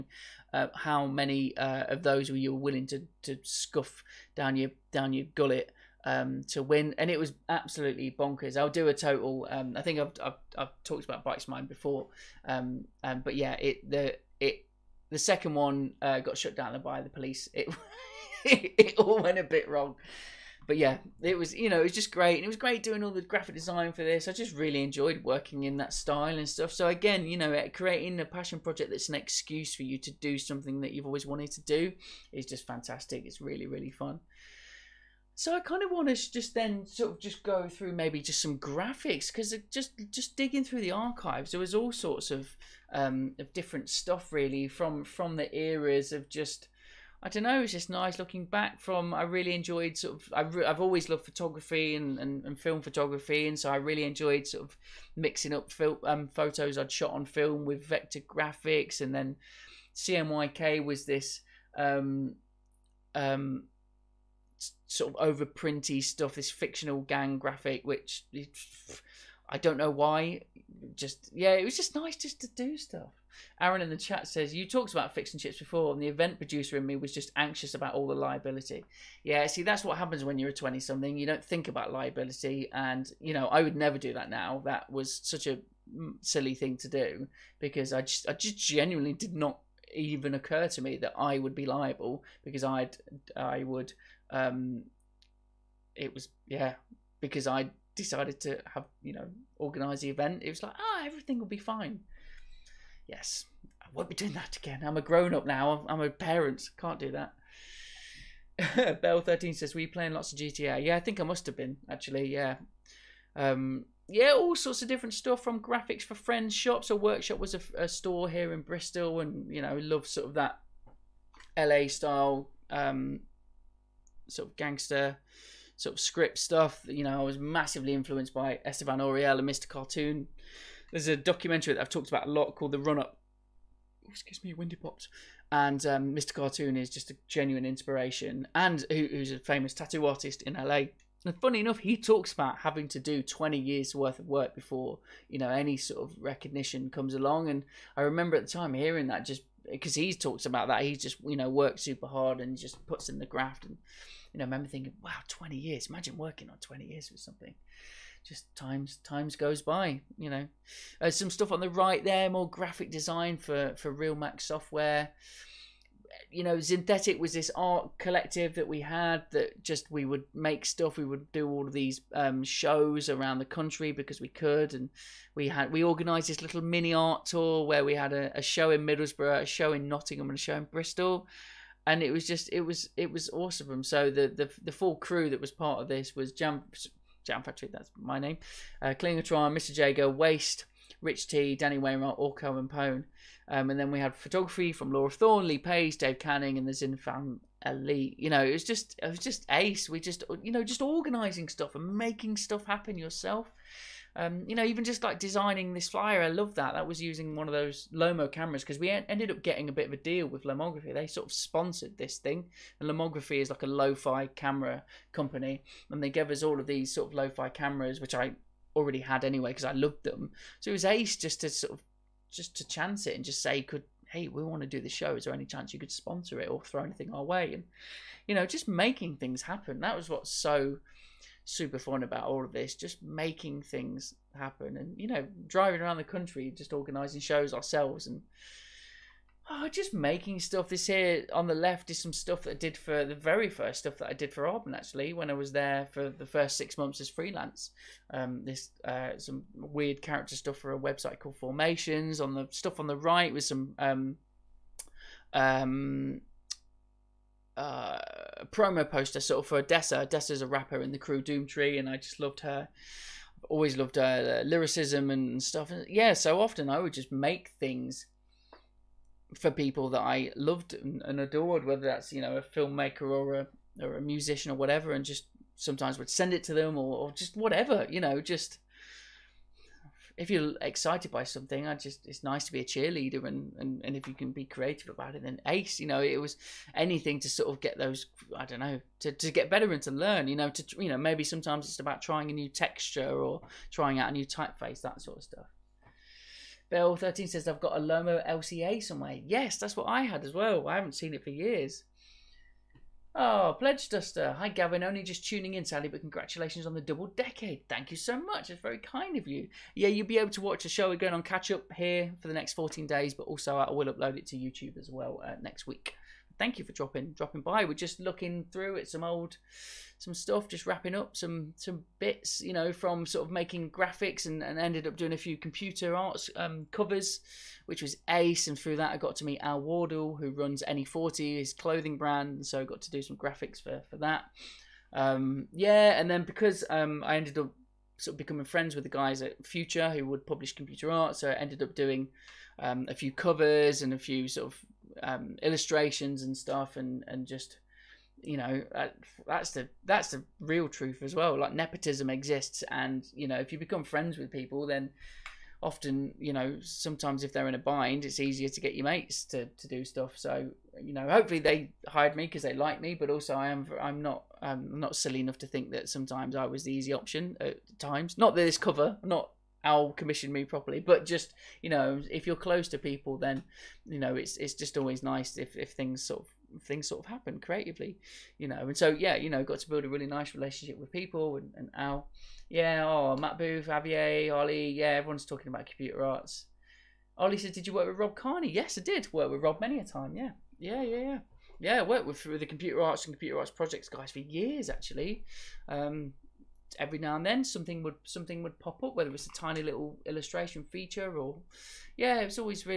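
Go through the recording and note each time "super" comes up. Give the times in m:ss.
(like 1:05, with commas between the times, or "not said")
2:31, 3:51.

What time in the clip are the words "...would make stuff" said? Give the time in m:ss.
2:50.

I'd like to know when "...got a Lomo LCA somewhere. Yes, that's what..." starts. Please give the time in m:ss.
4:57.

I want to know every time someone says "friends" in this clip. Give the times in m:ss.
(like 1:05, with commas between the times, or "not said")
1:56, 5:38, 5:53.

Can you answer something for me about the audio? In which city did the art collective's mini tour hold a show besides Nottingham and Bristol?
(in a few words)
Middlesbrough.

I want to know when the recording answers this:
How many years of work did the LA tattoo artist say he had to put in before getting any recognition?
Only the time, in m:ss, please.
2:23.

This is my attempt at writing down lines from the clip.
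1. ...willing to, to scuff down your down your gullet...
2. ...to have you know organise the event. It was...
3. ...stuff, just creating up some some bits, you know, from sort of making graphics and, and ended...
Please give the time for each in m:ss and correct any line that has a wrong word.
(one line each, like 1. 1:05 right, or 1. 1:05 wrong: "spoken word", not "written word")
1. 0:02 right
2. 1:38 right
3. 5:20 wrong: "wrapping", not "creating".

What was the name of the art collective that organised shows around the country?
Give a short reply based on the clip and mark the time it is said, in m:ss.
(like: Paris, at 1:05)
Synthetic, at 2:46.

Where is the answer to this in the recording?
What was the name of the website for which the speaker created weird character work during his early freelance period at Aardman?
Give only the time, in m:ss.
4:11.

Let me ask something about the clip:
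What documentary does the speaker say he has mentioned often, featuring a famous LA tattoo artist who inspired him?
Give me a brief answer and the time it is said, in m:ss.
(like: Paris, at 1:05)
The Run Up, at 2:12.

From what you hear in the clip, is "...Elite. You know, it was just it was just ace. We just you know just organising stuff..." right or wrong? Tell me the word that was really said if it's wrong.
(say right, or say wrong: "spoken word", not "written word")
right.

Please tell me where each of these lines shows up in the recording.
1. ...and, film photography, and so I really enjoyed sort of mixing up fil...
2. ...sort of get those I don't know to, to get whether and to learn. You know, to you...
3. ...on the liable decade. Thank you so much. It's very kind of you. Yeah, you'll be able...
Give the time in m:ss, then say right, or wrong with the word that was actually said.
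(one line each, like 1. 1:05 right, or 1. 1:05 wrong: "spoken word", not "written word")
1. 0:52 right
2. 4:47 wrong: "better", not "whether"
3. 5:06 wrong: "double", not "liable".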